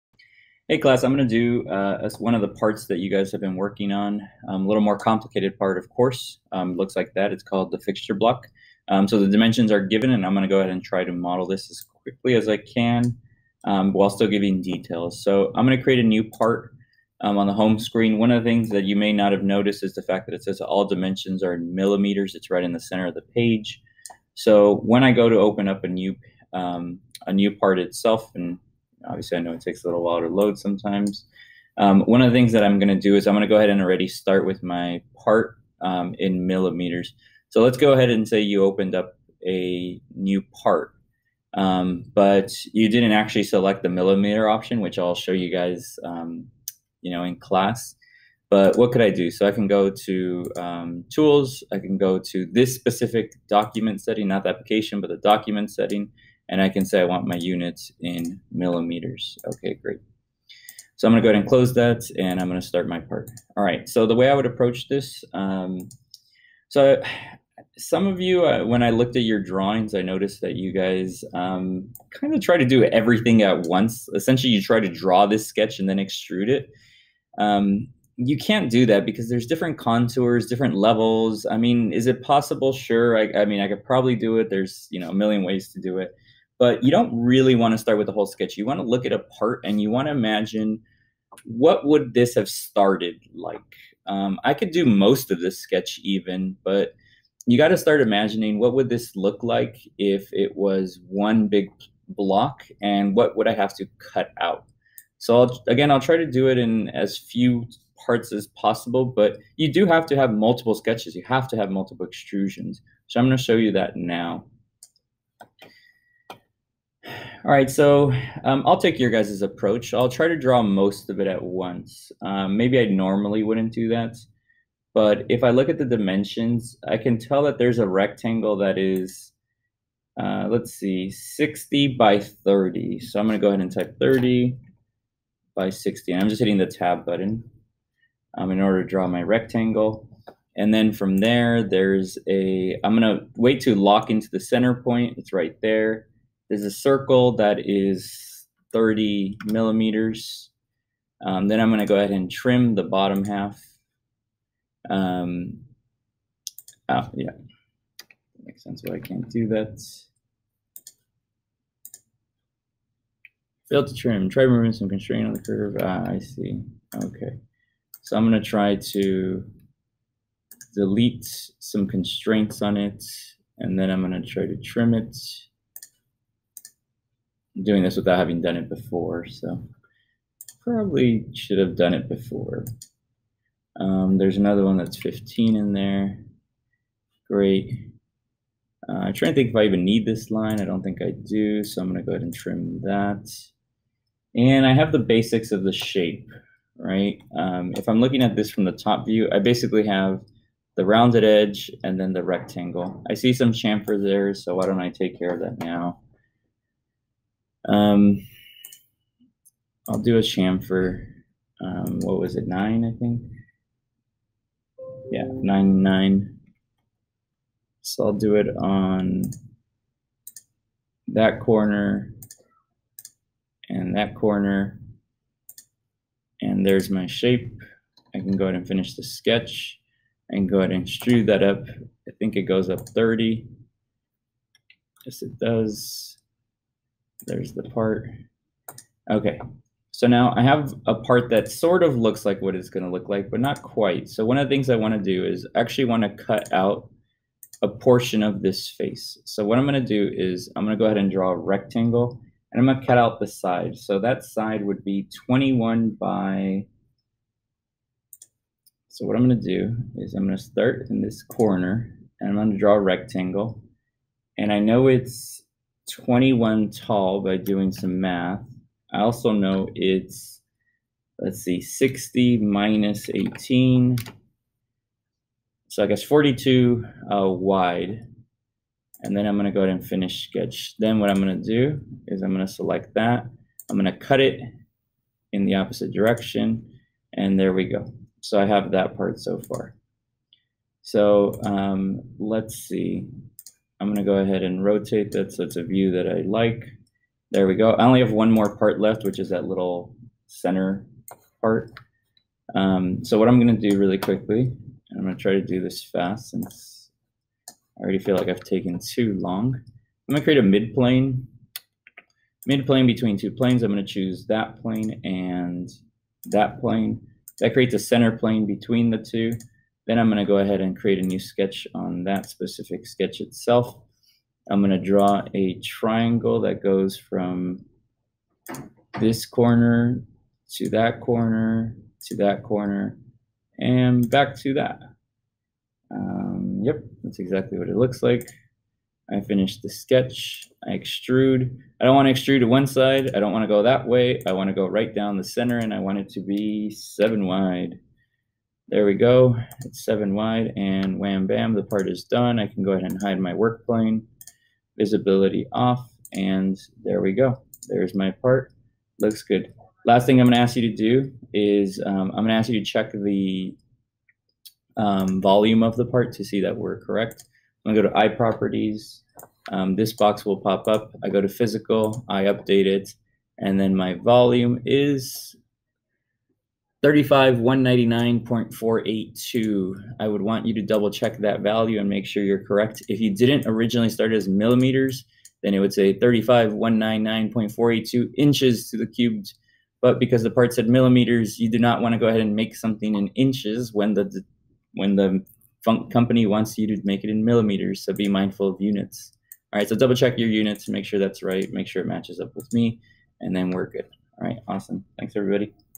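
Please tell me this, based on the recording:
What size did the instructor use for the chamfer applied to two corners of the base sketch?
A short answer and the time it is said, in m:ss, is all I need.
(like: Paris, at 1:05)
9, at 3:35.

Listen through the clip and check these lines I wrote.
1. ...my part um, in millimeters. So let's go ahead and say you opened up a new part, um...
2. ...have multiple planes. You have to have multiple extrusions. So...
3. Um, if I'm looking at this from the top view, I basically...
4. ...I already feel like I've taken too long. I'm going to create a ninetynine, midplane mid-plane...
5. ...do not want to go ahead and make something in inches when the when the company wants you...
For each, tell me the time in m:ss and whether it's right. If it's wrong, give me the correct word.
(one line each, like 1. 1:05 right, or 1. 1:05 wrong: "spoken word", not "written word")
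1. 0:34 right
2. 1:50 wrong: "sketches", not "planes"
3. 3:17 right
4. 5:07 wrong: "midplane", not "ninetynine"
5. 6:31 right.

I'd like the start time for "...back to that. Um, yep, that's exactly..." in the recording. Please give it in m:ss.
5:34.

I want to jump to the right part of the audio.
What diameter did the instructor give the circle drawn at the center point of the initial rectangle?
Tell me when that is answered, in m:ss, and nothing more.
2:28.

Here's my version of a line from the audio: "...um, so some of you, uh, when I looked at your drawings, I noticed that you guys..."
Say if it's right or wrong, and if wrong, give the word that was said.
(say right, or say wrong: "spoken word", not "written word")
right.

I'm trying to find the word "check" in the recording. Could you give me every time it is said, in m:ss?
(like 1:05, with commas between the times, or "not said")
6:02, 6:20, 6:39.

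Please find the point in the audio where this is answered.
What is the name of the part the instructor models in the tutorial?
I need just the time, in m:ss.
0:07.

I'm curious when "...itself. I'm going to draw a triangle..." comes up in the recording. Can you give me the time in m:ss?
5:23.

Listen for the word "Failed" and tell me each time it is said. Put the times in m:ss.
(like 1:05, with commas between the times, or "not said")
2:43.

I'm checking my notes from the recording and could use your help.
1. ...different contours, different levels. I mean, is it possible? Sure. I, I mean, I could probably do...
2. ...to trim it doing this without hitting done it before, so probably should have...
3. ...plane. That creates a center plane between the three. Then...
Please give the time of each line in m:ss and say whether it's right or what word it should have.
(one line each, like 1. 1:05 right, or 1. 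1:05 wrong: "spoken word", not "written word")
1. 1:19 right
2. 2:54 wrong: "having", not "hitting"
3. 5:16 wrong: "two", not "three".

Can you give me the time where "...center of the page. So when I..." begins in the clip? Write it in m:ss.
0:22.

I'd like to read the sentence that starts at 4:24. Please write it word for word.
And I know it's 21 tall by doing some math.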